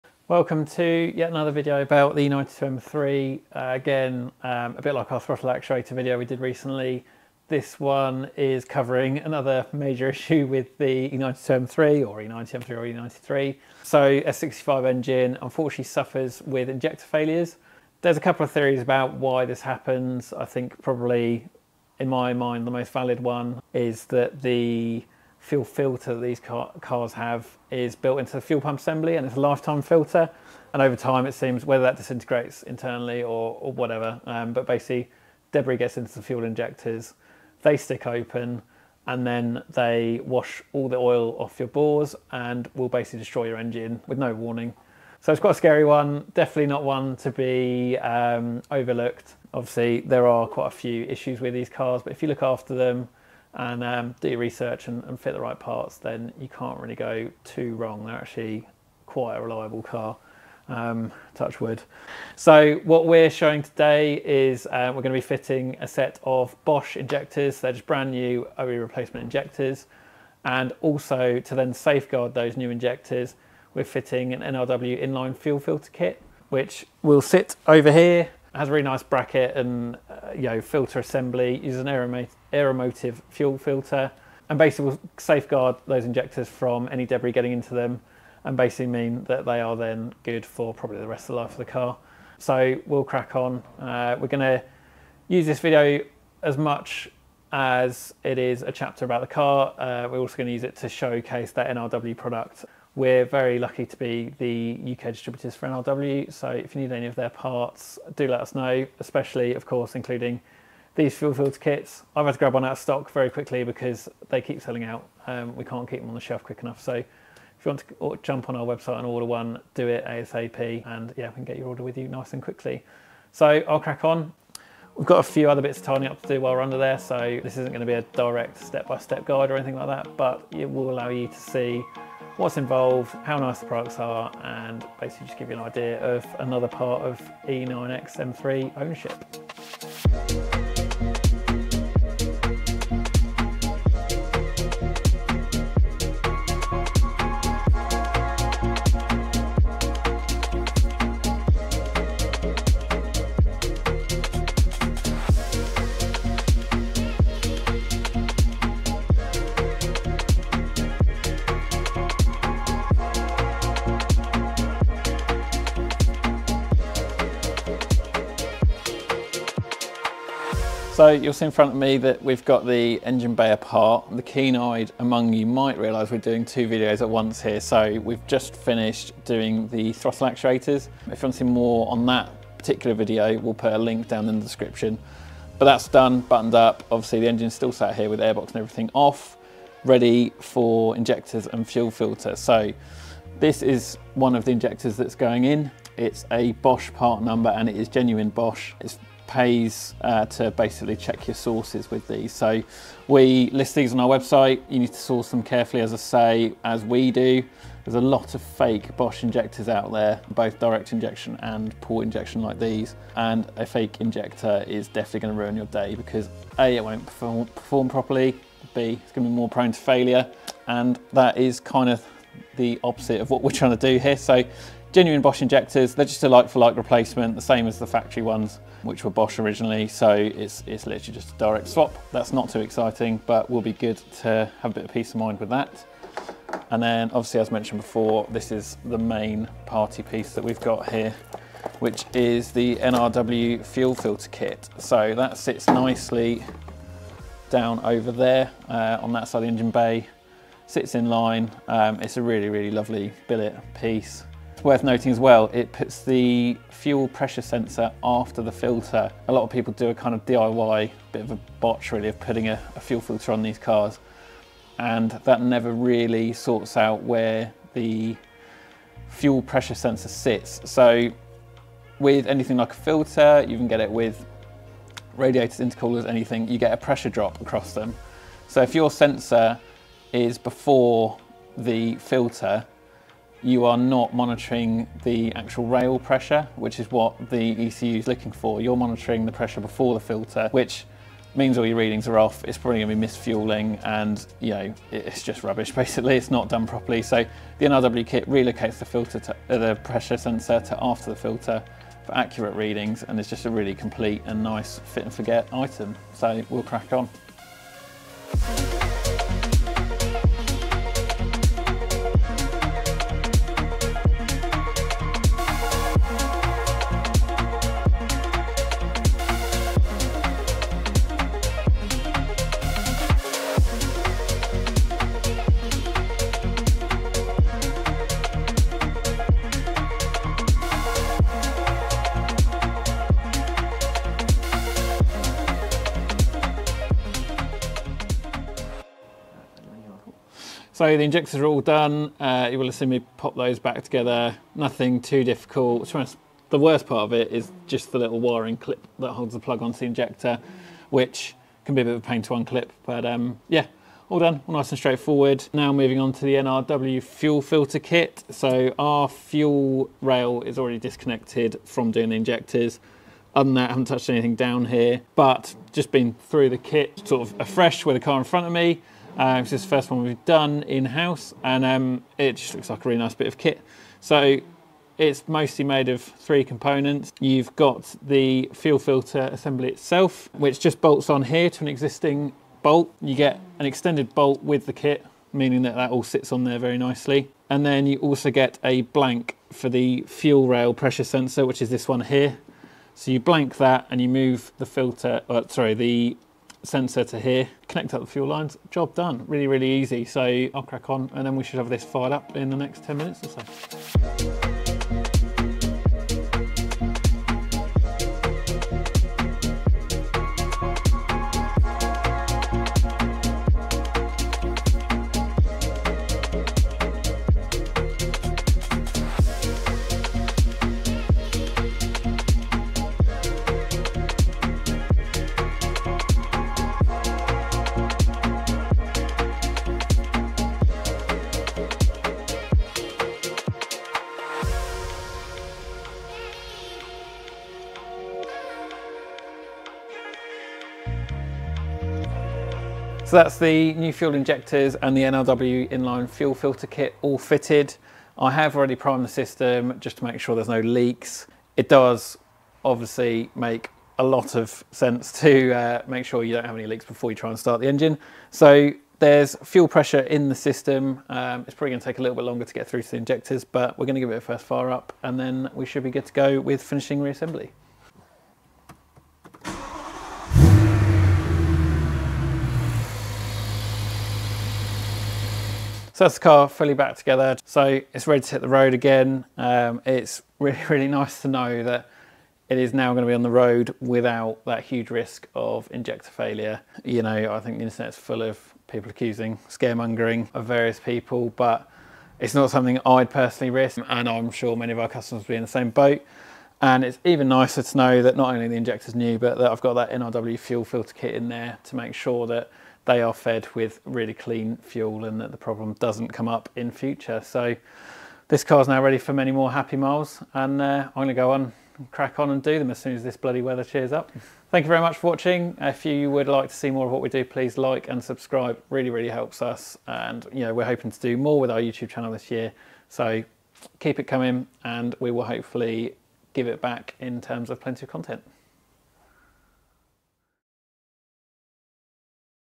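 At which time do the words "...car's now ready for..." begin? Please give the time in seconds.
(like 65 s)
508 s.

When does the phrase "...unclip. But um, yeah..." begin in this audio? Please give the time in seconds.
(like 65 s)
352 s.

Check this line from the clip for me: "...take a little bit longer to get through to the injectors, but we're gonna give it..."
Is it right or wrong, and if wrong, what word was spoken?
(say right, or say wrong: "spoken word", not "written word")
right.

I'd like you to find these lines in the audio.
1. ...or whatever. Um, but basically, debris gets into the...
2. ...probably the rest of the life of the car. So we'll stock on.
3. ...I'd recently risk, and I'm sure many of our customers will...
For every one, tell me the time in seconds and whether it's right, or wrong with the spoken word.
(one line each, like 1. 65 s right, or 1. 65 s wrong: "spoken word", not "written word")
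1. 33 s right
2. 90 s wrong: "crack", not "stock"
3. 492 s wrong: "personally", not "recently".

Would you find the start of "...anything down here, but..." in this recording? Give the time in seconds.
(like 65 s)
364 s.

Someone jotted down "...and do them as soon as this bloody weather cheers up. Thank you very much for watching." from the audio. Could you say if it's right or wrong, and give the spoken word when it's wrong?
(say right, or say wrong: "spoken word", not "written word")
right.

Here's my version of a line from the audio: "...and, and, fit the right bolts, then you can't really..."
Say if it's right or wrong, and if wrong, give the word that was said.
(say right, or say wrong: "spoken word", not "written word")
wrong: "parts", not "bolts".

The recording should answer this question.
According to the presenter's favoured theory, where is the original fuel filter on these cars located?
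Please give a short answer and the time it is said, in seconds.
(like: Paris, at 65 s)
Built into the fuel pump assembly, at 27 s.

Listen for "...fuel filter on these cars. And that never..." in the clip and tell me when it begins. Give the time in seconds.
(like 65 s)
262 s.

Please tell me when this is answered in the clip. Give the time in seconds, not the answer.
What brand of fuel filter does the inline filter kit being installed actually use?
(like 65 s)
82 s.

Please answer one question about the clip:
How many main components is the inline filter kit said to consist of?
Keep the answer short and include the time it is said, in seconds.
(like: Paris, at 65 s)
3, at 376 s.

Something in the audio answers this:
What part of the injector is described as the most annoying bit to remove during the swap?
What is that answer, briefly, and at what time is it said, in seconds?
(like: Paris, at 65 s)
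Little wiring clip, at 347 s.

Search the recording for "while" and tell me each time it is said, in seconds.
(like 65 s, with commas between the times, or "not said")
126 s.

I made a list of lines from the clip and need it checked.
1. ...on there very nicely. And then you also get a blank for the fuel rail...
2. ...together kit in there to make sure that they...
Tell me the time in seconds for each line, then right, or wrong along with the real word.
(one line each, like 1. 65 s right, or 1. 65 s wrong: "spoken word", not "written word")
1. 386 s right
2. 500 s wrong: "filter", not "together".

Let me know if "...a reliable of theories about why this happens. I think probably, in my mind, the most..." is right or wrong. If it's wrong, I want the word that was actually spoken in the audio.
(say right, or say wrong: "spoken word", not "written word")
wrong: "couple", not "reliable".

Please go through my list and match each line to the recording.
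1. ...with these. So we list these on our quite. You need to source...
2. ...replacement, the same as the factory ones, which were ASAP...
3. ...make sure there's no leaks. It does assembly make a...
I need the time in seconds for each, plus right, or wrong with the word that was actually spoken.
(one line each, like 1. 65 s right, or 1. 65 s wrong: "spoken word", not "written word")
1. 201 s wrong: "website", not "quite"
2. 226 s wrong: "Bosch", not "ASAP"
3. 450 s wrong: "obviously", not "assembly".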